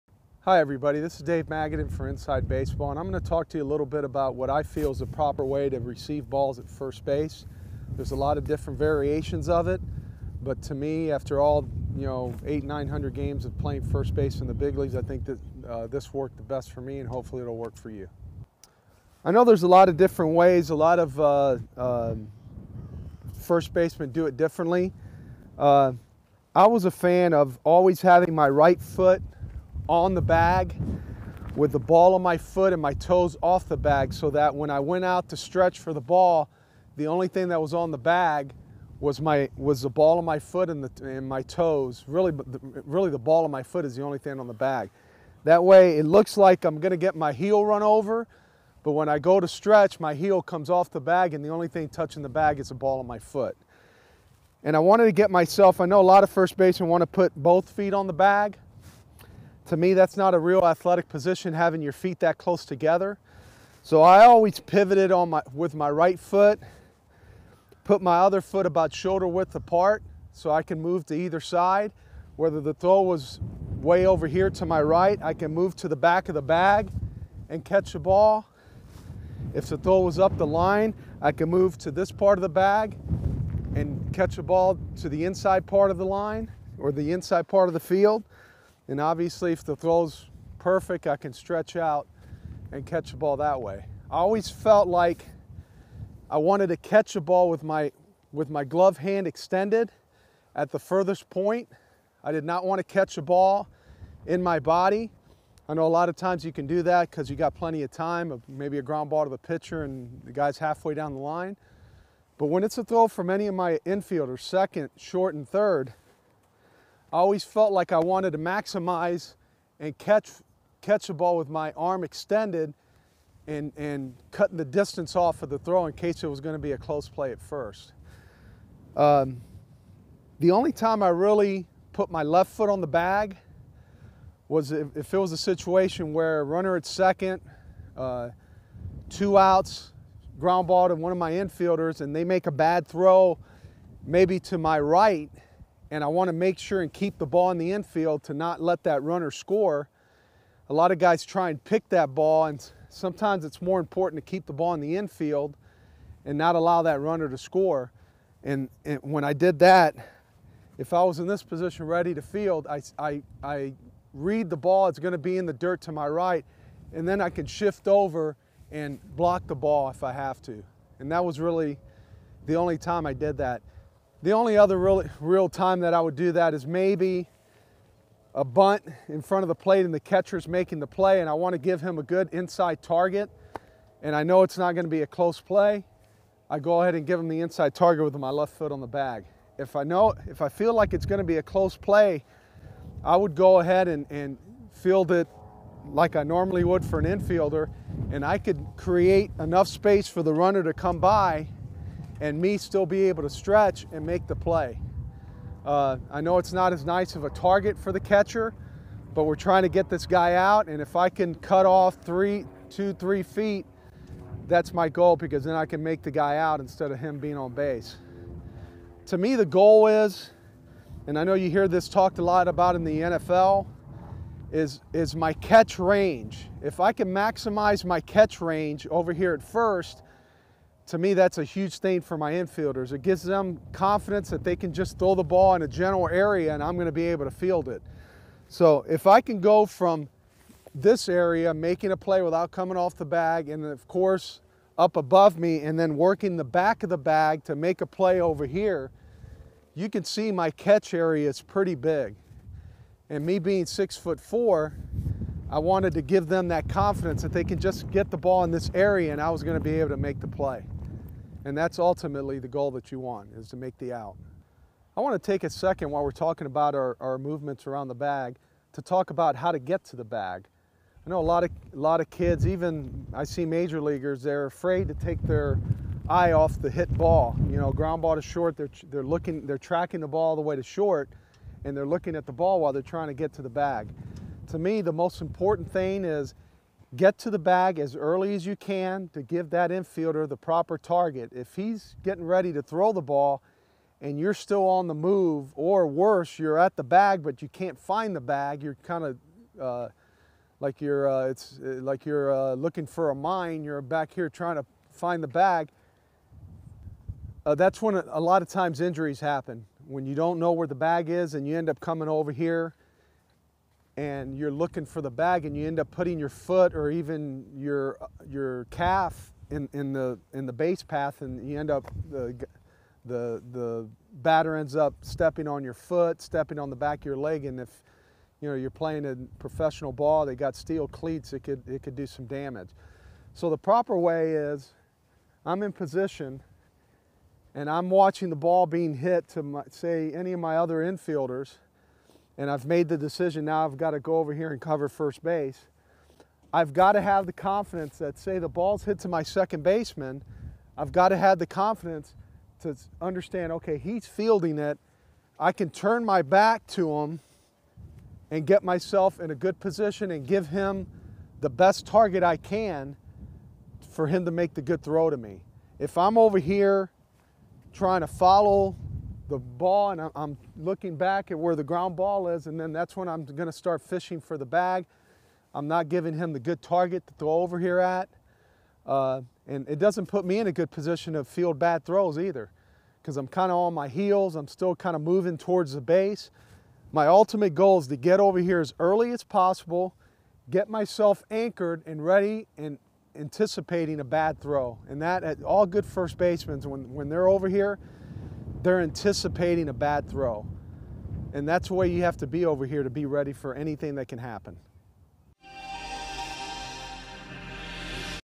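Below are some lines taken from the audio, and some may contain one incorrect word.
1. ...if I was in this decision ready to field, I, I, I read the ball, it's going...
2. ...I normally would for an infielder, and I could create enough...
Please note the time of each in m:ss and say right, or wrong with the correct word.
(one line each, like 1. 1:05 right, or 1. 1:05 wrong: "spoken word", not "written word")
1. 2:40 wrong: "position", not "decision"
2. 3:16 right.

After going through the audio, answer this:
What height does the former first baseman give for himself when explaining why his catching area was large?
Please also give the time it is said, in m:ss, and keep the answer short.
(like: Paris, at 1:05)
6 foot 4, at 4:13.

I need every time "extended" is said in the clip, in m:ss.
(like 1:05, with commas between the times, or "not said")
1:39, 2:02.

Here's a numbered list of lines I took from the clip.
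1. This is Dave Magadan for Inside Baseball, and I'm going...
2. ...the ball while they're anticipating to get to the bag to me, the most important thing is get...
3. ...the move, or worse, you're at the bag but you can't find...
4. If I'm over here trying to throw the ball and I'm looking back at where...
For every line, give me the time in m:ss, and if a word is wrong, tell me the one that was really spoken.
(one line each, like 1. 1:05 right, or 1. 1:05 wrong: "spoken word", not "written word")
1. 0:00 right
2. 4:42 wrong: "trying", not "anticipating"
3. 4:54 right
4. 6:05 wrong: "follow", not "throw".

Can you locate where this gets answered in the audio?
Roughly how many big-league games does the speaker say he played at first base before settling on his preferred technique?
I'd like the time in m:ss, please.
0:12.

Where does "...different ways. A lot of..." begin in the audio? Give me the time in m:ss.
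0:19.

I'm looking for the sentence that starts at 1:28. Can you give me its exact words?
And obviously if the throw's perfect, I can stretch out and catch the ball that way.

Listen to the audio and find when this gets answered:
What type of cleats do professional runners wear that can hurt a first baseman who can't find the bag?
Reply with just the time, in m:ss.
5:30.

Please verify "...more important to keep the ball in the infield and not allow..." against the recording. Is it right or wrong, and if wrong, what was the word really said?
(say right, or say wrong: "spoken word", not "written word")
right.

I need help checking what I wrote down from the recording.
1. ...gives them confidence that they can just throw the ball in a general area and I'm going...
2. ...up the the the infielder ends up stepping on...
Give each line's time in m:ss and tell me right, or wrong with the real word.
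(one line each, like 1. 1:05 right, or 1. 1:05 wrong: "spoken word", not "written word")
1. 3:53 right
2. 5:21 wrong: "batter", not "infielder".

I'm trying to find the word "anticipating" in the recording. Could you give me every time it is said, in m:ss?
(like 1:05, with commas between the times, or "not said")
6:33, 6:38.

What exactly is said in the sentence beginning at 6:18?
Uh, and it doesn't put me in a good position to field bad throws either because I'm kind of on my heels.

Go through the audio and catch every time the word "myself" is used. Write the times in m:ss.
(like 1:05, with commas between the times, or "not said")
0:55, 5:58, 6:30.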